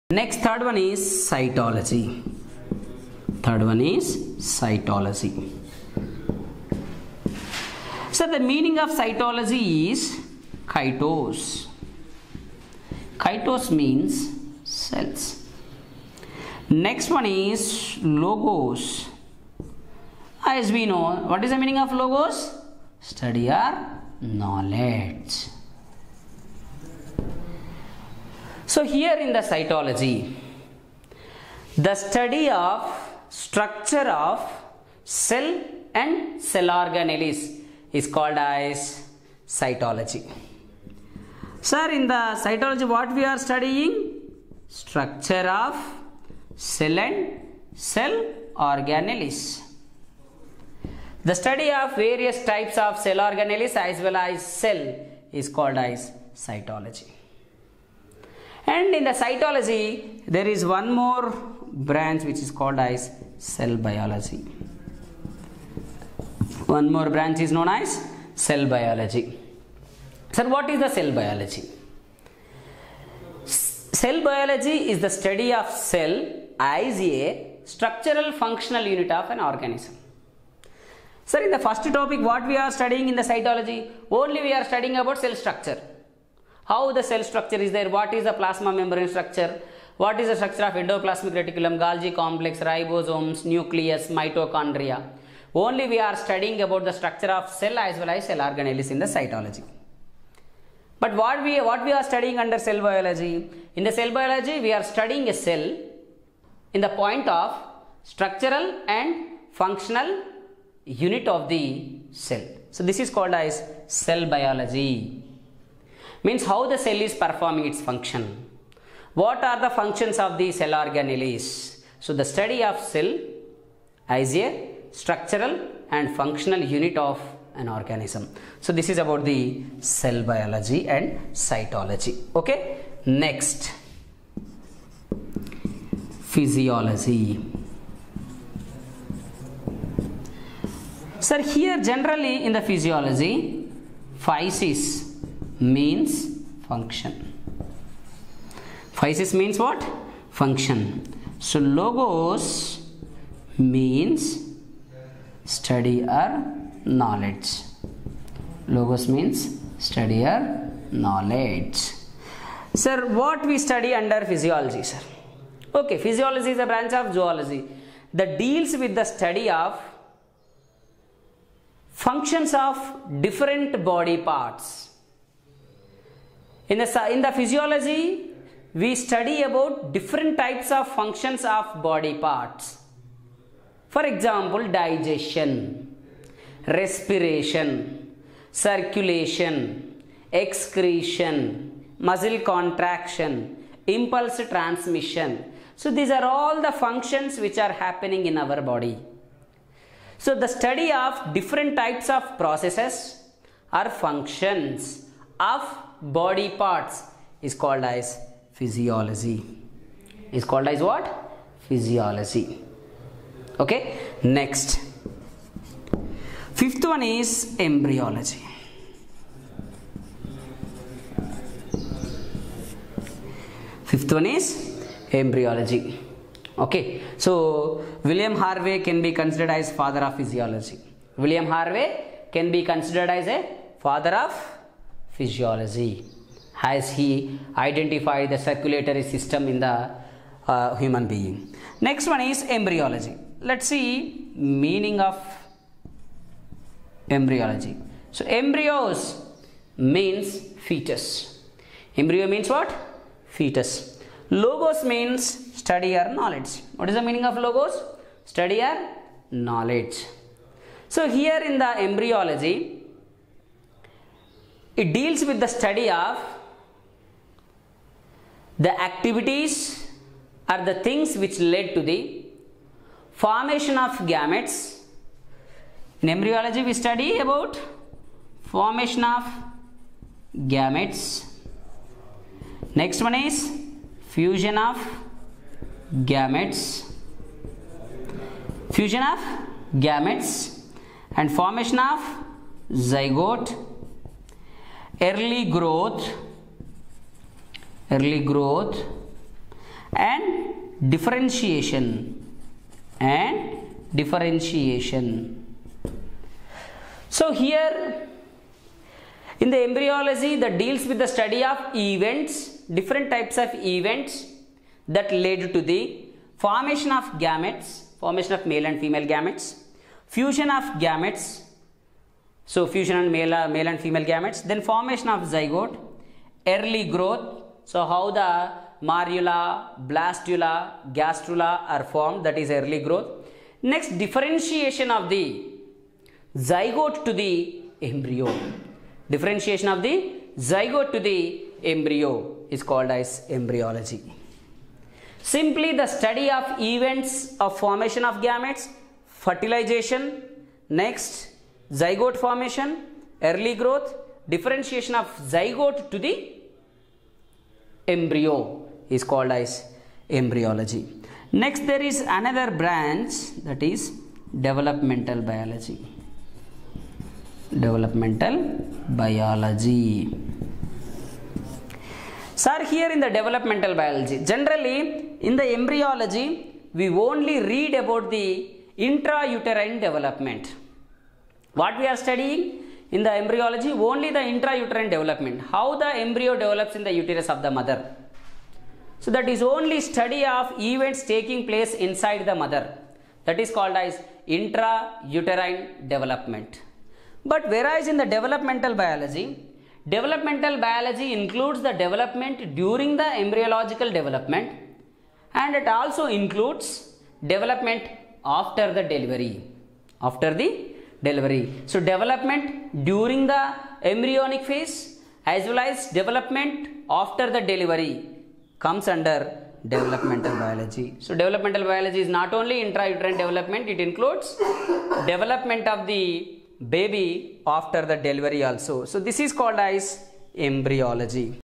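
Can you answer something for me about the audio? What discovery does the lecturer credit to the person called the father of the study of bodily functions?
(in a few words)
the circulatory system.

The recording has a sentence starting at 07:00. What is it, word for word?
So developmental biology is not only intrauterine development, it includes development of the baby after the delivery also.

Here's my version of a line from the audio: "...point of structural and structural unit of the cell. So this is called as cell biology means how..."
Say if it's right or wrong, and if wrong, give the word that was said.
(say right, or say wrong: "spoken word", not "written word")
wrong: "functional", not "structural".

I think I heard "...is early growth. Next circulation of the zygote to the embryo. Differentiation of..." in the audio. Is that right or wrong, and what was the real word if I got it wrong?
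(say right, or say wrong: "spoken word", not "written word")
wrong: "differentiation", not "circulation".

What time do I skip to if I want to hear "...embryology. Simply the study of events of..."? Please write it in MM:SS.
05:43.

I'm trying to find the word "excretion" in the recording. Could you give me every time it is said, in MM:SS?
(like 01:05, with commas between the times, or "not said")
03:10.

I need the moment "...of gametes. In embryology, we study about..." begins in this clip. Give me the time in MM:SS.
04:33.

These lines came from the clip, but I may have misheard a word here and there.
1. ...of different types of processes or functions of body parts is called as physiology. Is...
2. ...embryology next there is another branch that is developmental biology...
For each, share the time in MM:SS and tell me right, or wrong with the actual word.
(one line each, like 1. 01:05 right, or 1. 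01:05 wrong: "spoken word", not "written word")
1. 03:20 right
2. 06:00 right.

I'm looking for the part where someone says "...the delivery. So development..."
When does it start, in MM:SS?
06:50.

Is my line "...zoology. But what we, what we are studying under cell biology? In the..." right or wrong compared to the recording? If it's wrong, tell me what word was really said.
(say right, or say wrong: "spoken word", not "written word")
wrong: "cytology", not "zoology".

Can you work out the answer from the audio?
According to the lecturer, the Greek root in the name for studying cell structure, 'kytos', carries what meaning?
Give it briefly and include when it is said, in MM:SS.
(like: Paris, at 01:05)
cells, at 00:13.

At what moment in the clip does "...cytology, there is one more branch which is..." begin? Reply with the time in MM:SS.
00:59.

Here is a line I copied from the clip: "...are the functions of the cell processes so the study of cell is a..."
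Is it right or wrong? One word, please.
wrong.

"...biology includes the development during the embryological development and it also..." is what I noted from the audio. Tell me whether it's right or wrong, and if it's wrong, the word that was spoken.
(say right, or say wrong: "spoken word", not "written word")
right.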